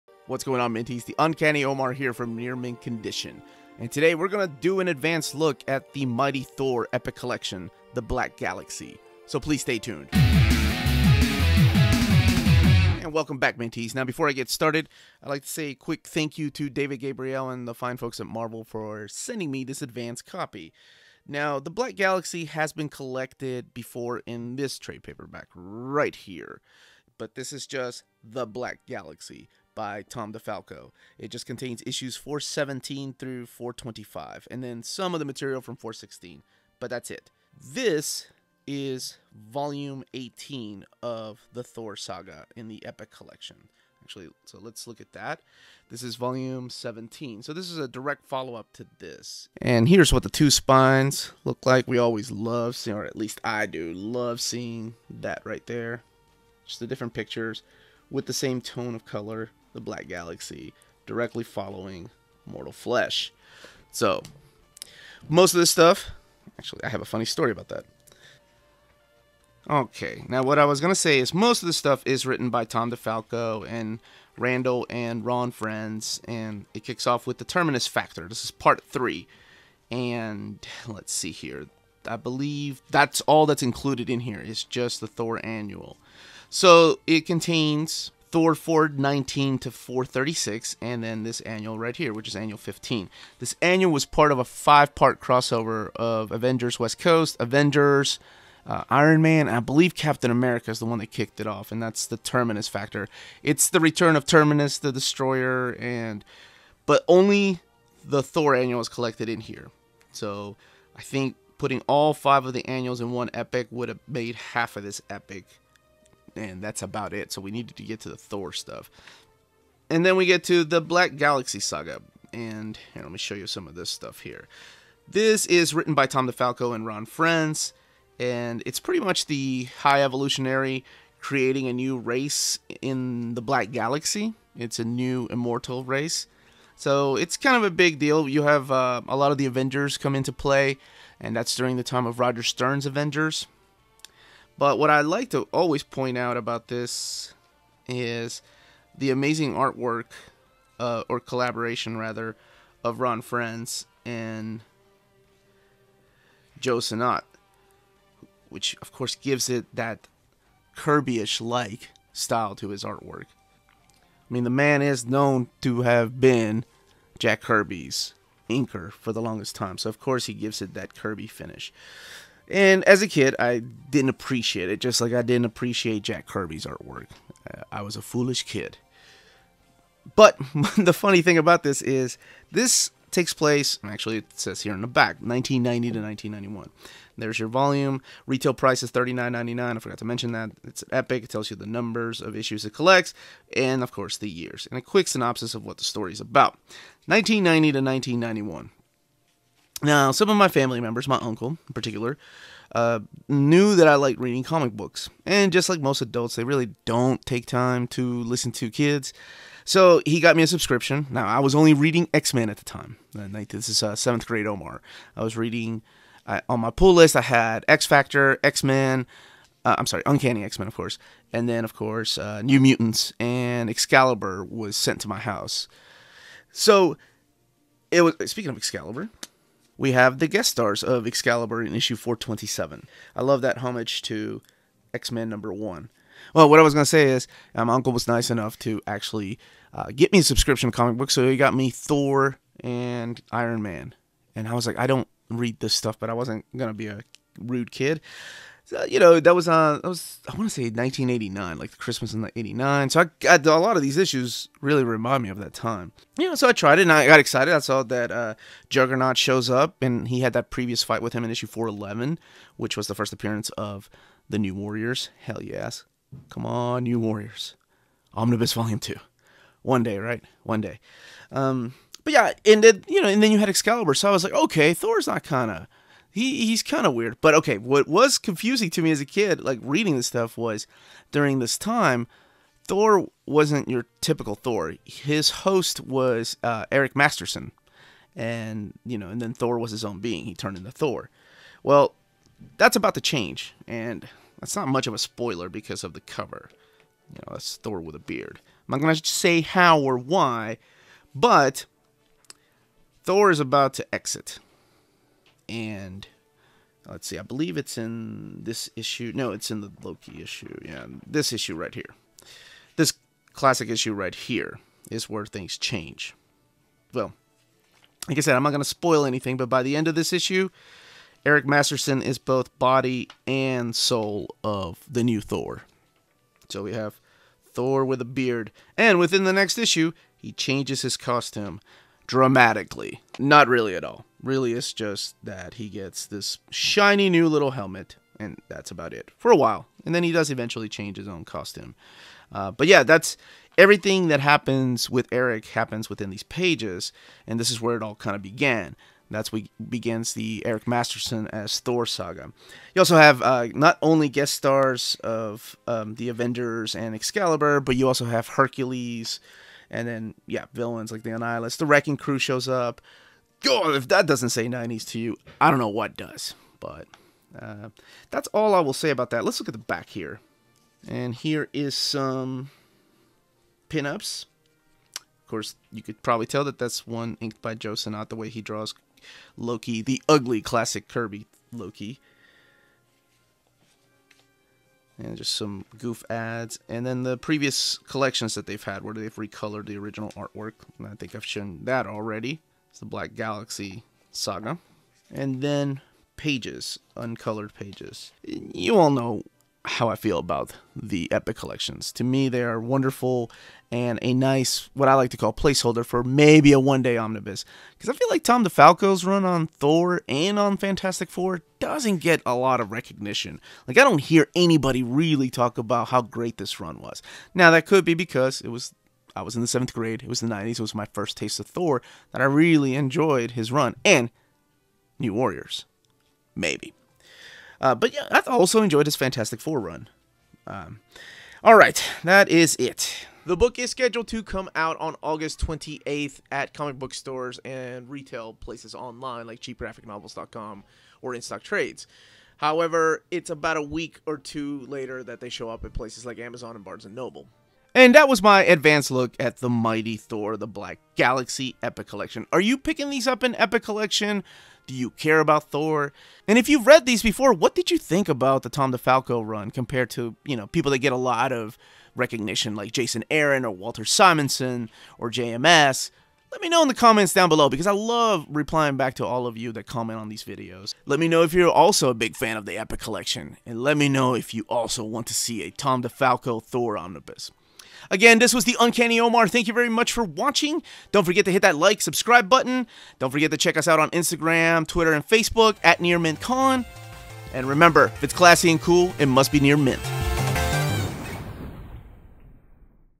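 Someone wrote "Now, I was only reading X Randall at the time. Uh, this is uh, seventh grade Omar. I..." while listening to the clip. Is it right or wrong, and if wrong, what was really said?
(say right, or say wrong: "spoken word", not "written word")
wrong: "Men", not "Randall".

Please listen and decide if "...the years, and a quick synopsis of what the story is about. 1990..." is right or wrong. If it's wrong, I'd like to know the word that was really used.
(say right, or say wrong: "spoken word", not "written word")
right.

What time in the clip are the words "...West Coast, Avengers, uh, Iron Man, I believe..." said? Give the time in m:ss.
1:36.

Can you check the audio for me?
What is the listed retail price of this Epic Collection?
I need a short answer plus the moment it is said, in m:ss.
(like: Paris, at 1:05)
$39.99, at 3:08.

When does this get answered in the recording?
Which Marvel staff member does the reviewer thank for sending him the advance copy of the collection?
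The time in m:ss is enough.
0:16.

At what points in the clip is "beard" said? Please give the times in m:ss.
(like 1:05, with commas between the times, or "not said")
4:57, 5:28.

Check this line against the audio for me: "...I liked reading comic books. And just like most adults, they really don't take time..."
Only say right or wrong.
right.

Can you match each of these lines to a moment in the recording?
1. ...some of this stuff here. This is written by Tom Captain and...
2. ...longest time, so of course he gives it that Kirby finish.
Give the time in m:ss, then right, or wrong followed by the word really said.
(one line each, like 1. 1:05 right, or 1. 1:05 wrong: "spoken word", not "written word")
1. 2:03 wrong: "DeFalco", not "Captain"
2. 2:49 right.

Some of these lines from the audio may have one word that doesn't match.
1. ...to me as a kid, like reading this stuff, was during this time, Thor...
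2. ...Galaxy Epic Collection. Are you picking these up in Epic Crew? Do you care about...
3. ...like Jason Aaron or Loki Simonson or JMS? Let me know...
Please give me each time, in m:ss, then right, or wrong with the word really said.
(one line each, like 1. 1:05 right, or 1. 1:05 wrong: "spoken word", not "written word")
1. 4:38 right
2. 7:30 wrong: "Collection", not "Crew"
3. 7:42 wrong: "Walter", not "Loki".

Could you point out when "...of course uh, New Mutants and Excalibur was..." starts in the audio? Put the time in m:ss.
3:41.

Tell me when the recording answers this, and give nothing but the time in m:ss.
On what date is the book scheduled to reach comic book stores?
7:15.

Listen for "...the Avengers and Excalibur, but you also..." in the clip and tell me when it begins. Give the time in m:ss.
5:55.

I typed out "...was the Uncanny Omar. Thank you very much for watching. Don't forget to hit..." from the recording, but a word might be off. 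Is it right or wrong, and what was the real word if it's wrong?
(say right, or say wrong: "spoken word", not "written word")
right.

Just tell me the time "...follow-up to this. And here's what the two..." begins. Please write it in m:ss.
0:48.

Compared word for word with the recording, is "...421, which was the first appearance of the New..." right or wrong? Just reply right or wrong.
wrong.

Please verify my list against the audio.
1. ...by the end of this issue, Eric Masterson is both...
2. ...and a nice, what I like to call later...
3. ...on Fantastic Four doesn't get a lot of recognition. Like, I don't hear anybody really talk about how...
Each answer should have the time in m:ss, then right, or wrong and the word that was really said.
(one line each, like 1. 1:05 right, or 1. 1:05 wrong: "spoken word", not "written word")
1. 5:19 right
2. 6:43 wrong: "placeholder", not "later"
3. 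6:50 right.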